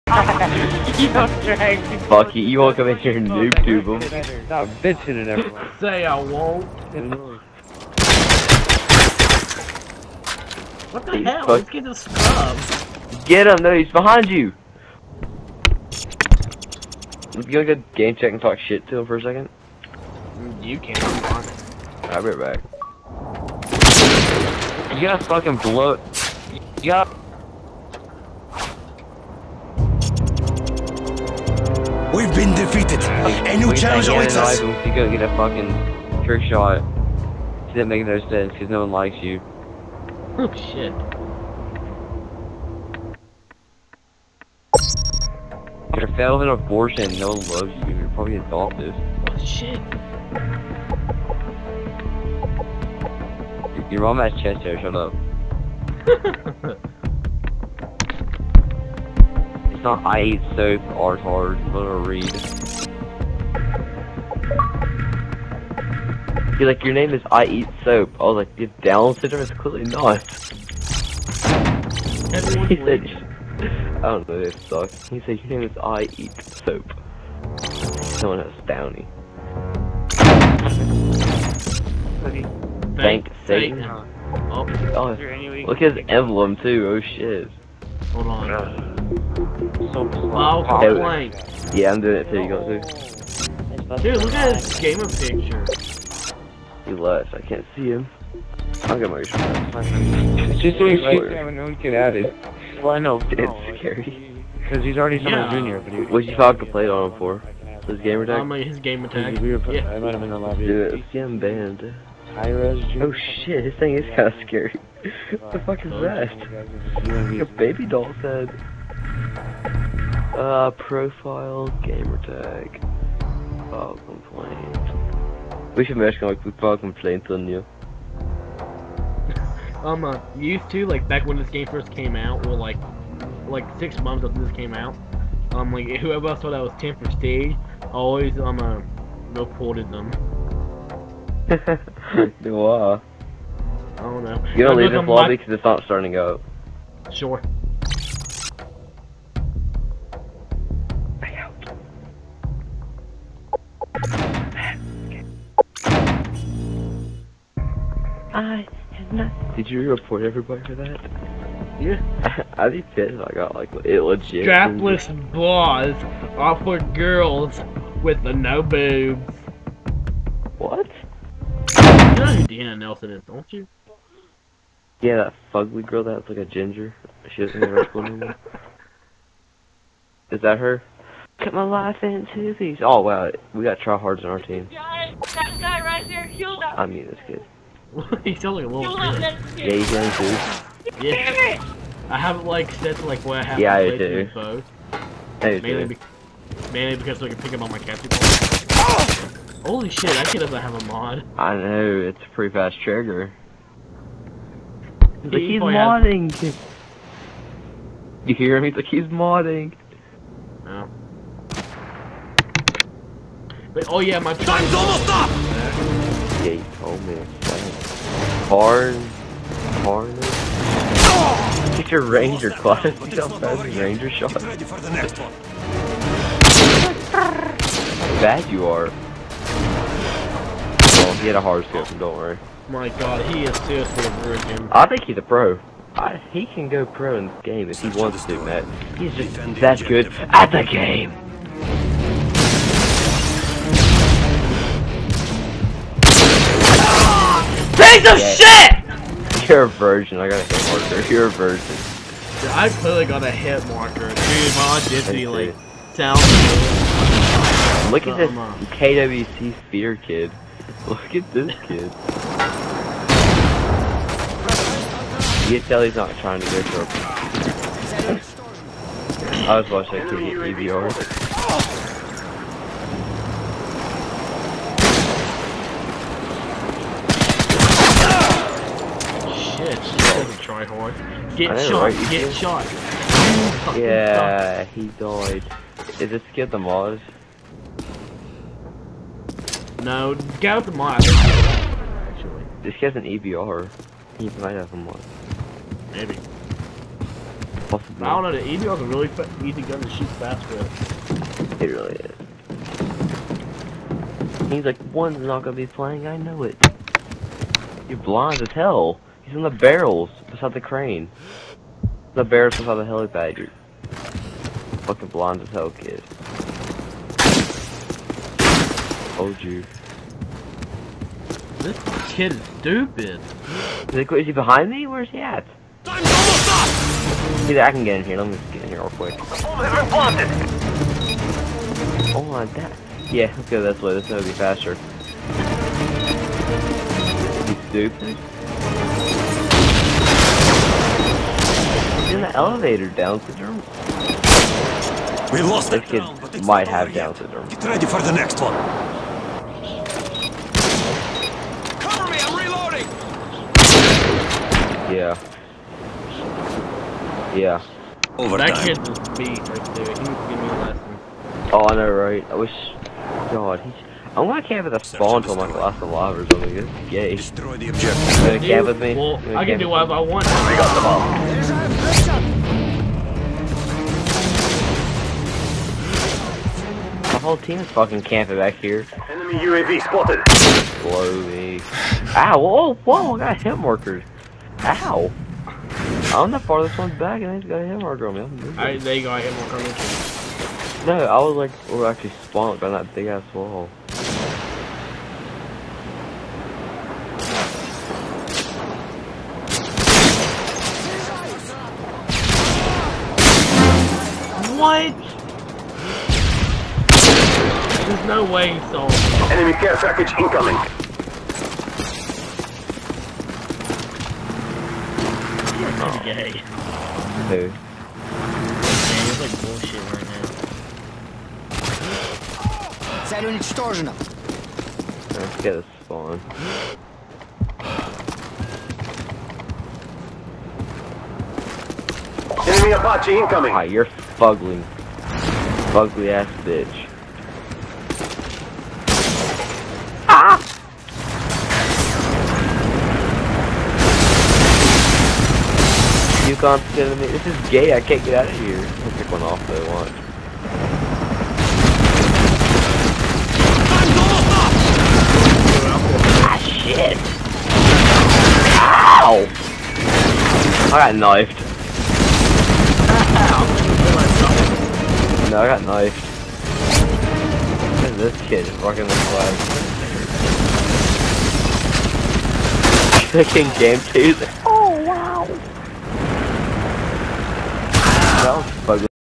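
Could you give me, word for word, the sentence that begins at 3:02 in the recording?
Oh wow, we got tryhards on our team.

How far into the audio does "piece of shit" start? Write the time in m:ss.
4:07.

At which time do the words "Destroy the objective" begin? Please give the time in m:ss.
6:07.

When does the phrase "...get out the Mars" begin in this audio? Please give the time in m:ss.
4:50.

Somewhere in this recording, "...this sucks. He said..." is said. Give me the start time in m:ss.
1:14.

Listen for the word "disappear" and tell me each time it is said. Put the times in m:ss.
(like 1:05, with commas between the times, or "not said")
not said.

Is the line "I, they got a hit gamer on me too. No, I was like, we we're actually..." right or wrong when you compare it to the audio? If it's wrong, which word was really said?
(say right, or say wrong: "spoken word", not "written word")
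wrong: "marker", not "gamer".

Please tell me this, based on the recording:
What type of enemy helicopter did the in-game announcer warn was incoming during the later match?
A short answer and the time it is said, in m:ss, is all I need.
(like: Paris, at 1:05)
Apache, at 7:12.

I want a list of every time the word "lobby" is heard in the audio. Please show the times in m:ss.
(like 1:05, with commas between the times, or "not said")
1:50, 2:25.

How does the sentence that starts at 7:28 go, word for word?
I'll pick one off though, watch.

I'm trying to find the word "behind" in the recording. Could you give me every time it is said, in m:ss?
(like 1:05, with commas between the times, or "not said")
0:13, 5:24.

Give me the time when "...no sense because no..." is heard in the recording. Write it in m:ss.
0:38.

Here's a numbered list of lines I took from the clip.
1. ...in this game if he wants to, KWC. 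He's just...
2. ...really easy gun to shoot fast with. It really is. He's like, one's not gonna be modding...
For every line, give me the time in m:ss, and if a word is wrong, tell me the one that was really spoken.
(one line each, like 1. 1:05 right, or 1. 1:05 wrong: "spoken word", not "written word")
1. 3:57 wrong: "Matt", not "KWC"
2. 4:58 wrong: "playing", not "modding".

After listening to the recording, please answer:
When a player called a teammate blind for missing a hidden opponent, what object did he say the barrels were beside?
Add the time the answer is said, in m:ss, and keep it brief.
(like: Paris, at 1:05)
crane, at 5:10.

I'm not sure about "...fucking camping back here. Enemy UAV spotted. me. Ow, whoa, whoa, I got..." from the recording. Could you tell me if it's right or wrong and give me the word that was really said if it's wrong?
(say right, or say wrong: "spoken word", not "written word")
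right.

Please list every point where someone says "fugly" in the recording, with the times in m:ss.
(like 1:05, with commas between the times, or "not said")
2:55, 7:15.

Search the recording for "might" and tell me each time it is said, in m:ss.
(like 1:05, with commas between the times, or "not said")
1:49, 4:54, 5:46.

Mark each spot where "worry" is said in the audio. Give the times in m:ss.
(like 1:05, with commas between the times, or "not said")
3:52.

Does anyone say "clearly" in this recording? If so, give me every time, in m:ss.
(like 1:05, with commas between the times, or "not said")
1:09, 4:12.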